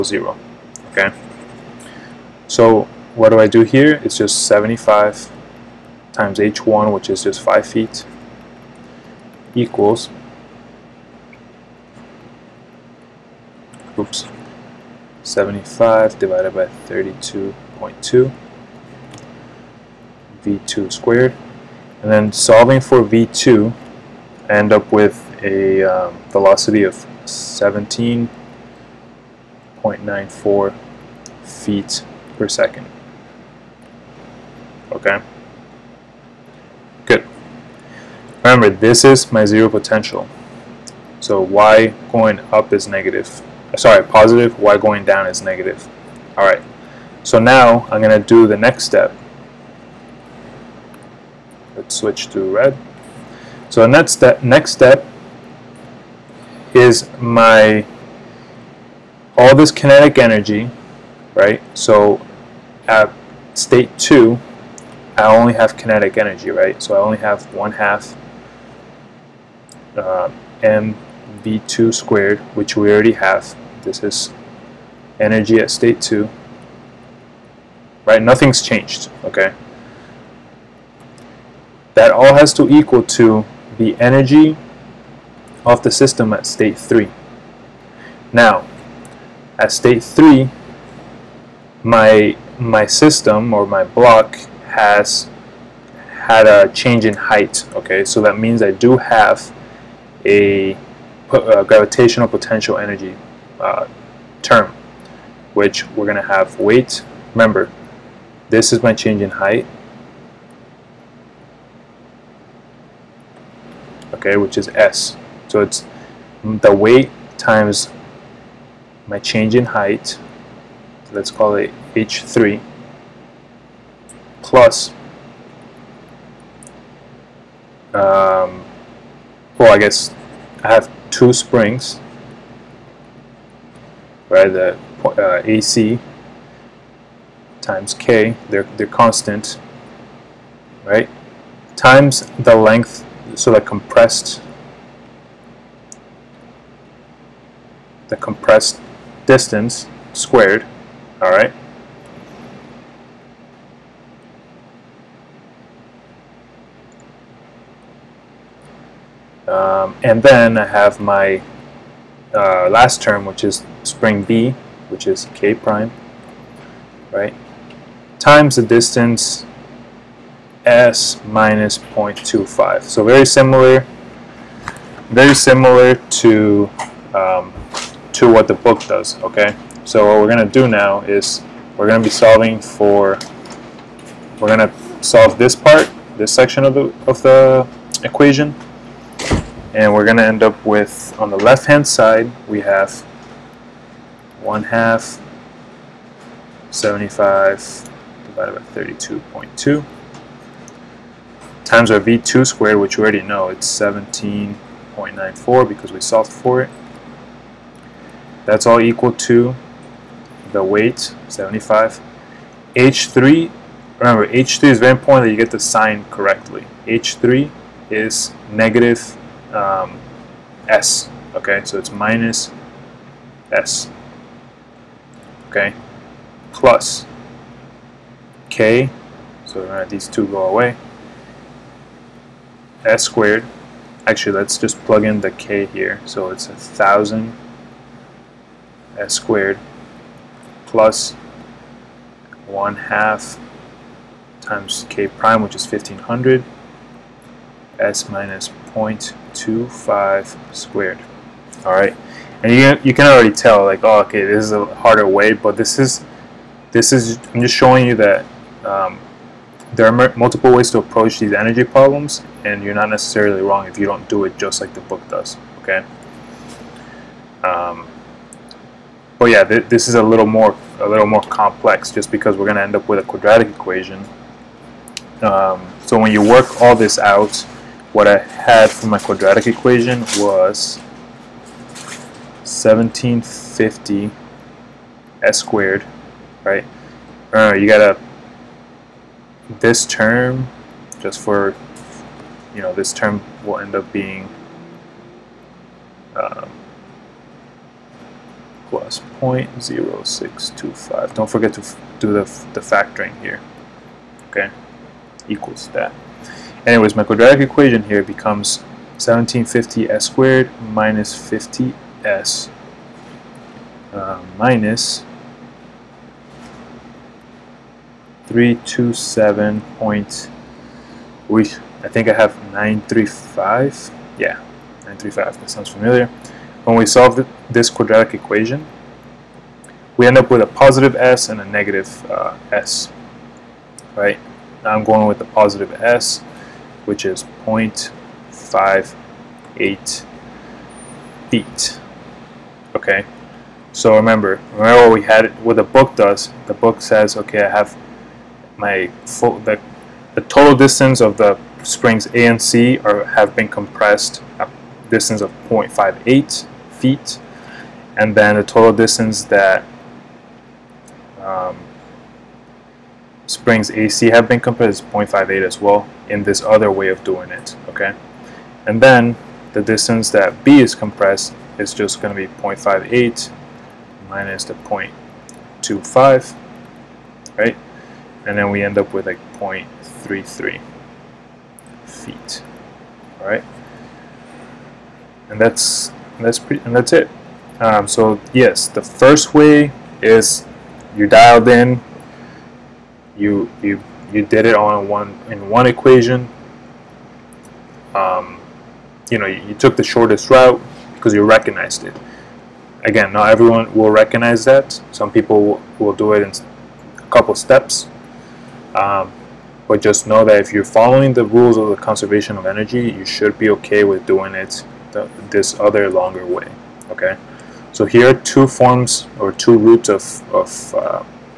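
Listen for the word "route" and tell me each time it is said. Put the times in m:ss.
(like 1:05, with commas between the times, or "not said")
6:40, 6:59.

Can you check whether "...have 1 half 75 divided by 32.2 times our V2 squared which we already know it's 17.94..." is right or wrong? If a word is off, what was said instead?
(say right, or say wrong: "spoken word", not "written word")
right.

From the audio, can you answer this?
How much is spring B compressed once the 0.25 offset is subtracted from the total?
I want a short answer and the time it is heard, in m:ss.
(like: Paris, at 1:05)
0.33 feet, at 6:19.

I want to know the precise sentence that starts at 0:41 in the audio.
So y going up is negative.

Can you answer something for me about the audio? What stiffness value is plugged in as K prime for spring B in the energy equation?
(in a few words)
1500.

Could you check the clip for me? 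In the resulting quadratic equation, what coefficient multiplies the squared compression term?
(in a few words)
1750.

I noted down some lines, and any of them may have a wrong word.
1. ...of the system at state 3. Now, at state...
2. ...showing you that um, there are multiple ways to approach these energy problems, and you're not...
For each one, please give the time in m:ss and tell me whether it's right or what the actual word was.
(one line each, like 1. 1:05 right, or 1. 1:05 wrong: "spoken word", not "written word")
1. 1:25 right
2. 4:17 right.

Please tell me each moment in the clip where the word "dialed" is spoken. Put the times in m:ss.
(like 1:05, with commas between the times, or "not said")
6:31.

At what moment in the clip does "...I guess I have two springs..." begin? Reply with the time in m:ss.
2:09.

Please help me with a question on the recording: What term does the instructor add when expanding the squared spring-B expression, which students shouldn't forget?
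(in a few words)
0.0625.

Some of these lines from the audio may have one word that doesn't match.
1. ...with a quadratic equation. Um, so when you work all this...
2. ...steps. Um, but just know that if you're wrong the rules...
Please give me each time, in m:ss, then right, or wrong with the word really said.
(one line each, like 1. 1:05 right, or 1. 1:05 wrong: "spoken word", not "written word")
1. 4:32 right
2. 6:47 wrong: "following", not "wrong".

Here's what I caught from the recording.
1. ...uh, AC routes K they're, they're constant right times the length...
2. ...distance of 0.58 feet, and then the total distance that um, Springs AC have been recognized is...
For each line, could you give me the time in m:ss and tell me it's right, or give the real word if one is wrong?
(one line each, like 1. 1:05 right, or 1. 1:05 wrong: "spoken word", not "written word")
1. 2:15 wrong: "times", not "routes"
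2. 5:54 wrong: "compared", not "recognized".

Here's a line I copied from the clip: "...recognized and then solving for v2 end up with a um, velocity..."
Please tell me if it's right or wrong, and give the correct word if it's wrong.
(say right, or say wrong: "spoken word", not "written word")
wrong: "squared", not "recognized".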